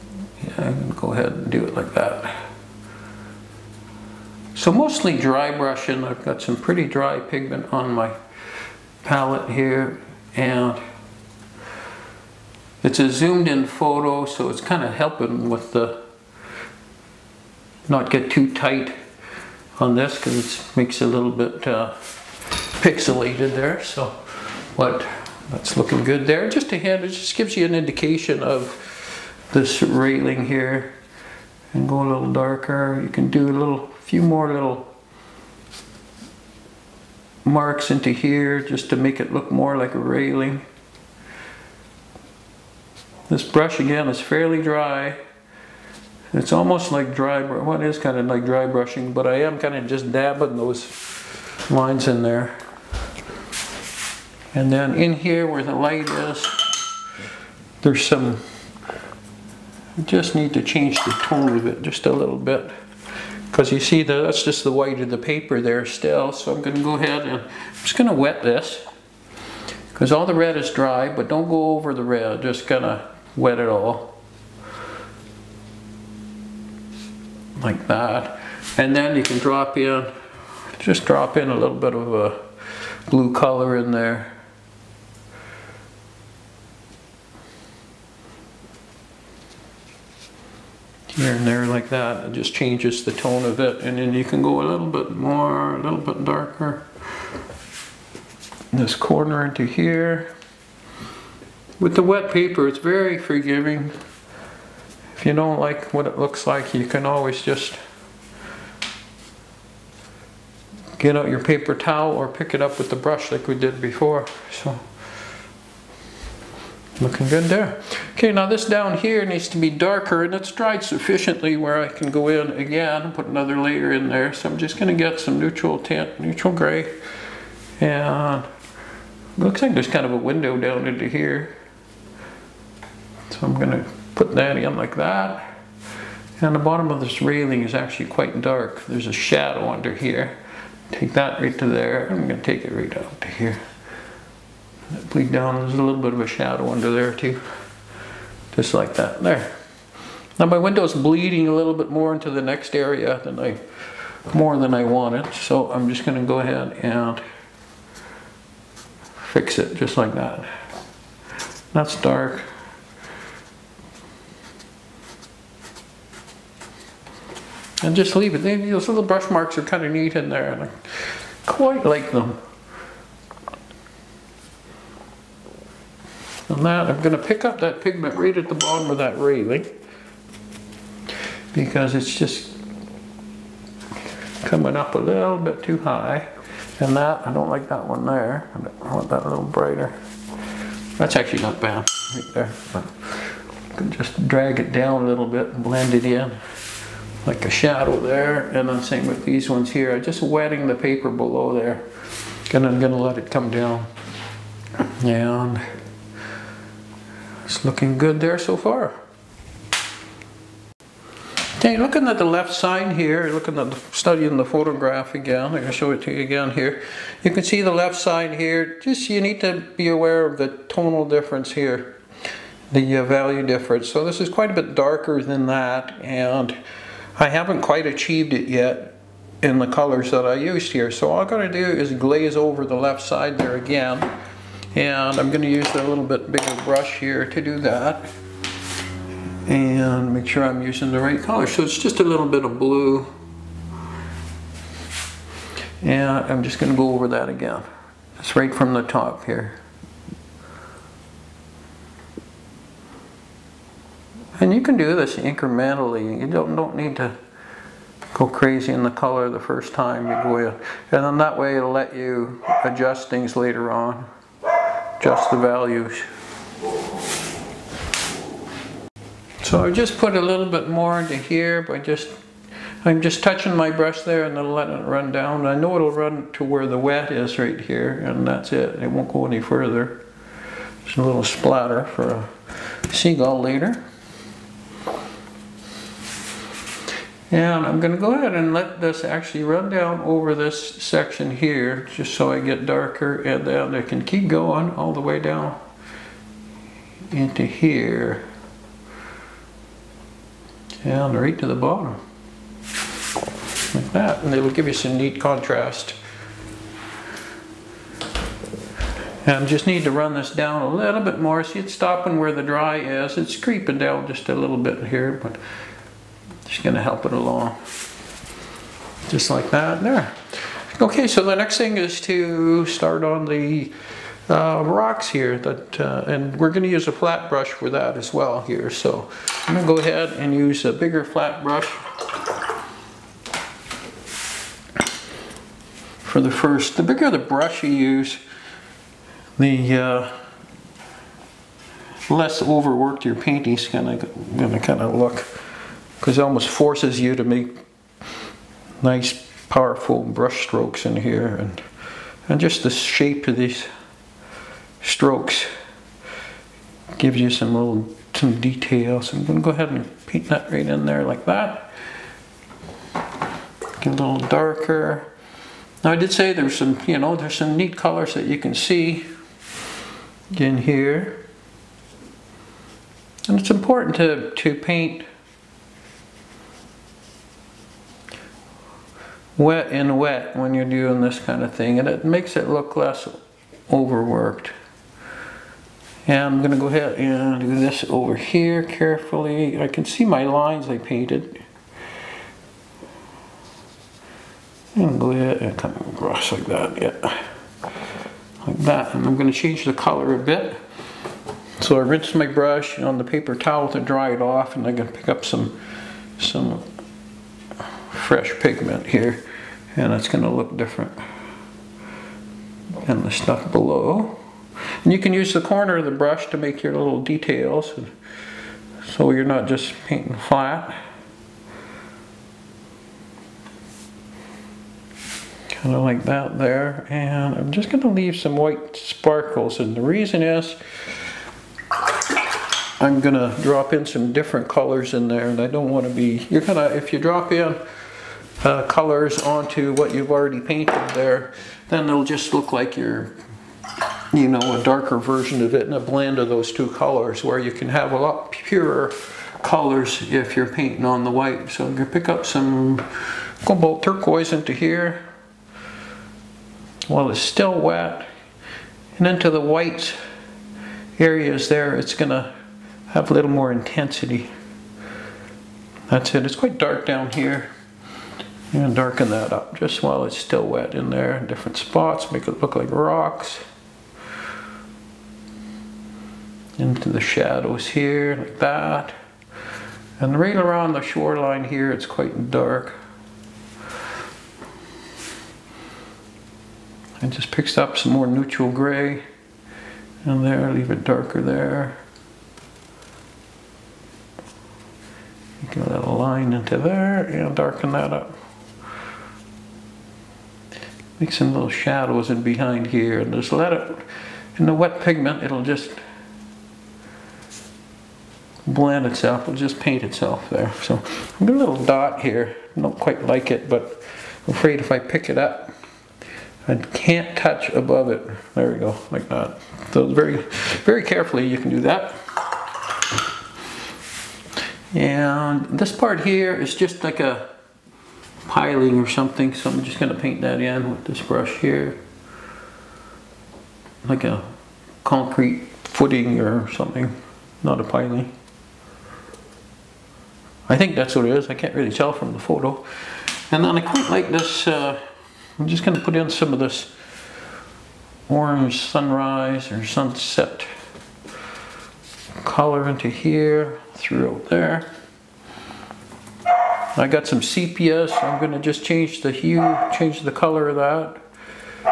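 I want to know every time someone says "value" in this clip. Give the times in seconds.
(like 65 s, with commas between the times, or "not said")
223 s, 265 s.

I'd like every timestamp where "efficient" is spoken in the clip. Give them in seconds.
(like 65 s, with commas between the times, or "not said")
not said.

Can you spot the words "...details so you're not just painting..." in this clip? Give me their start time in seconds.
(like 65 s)
417 s.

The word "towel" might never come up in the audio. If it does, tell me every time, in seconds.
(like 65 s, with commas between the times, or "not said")
111 s, 403 s.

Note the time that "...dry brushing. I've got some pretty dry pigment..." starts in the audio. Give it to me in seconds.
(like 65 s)
5 s.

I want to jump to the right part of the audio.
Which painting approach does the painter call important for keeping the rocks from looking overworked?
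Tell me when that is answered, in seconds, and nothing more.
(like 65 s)
379 s.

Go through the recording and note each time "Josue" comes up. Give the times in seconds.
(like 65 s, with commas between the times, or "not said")
not said.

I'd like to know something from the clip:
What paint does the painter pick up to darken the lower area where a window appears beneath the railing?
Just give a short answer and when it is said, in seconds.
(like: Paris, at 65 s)
neutral tint, at 125 s.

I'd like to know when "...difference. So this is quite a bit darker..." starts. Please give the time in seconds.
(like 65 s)
223 s.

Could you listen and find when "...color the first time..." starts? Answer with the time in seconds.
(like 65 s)
258 s.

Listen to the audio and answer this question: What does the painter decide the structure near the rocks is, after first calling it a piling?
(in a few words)
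concrete footing.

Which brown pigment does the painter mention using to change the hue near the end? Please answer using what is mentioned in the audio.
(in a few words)
sepia.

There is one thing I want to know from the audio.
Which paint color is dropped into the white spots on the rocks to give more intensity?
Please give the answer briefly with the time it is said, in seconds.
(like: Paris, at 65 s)
cobalt turquoise, at 453 s.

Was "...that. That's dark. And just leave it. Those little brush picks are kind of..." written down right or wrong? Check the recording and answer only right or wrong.
wrong.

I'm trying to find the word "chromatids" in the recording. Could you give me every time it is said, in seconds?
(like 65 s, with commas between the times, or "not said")
not said.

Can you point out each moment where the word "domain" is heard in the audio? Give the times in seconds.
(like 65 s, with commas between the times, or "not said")
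not said.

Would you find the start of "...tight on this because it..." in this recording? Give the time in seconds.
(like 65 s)
18 s.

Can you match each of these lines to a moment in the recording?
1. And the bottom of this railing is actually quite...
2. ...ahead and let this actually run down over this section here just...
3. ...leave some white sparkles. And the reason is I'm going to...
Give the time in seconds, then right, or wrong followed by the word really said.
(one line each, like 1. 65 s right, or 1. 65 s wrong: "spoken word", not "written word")
1. 136 s right
2. 288 s right
3. 427 s right.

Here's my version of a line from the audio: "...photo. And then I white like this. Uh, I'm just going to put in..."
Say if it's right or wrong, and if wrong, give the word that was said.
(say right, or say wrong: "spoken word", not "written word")
wrong: "quite", not "white".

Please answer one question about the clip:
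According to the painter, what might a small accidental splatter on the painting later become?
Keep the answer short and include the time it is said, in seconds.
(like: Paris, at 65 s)
a seagull, at 282 s.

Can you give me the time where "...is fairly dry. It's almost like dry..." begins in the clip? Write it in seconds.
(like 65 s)
44 s.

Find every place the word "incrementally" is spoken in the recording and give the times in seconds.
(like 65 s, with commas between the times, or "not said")
255 s.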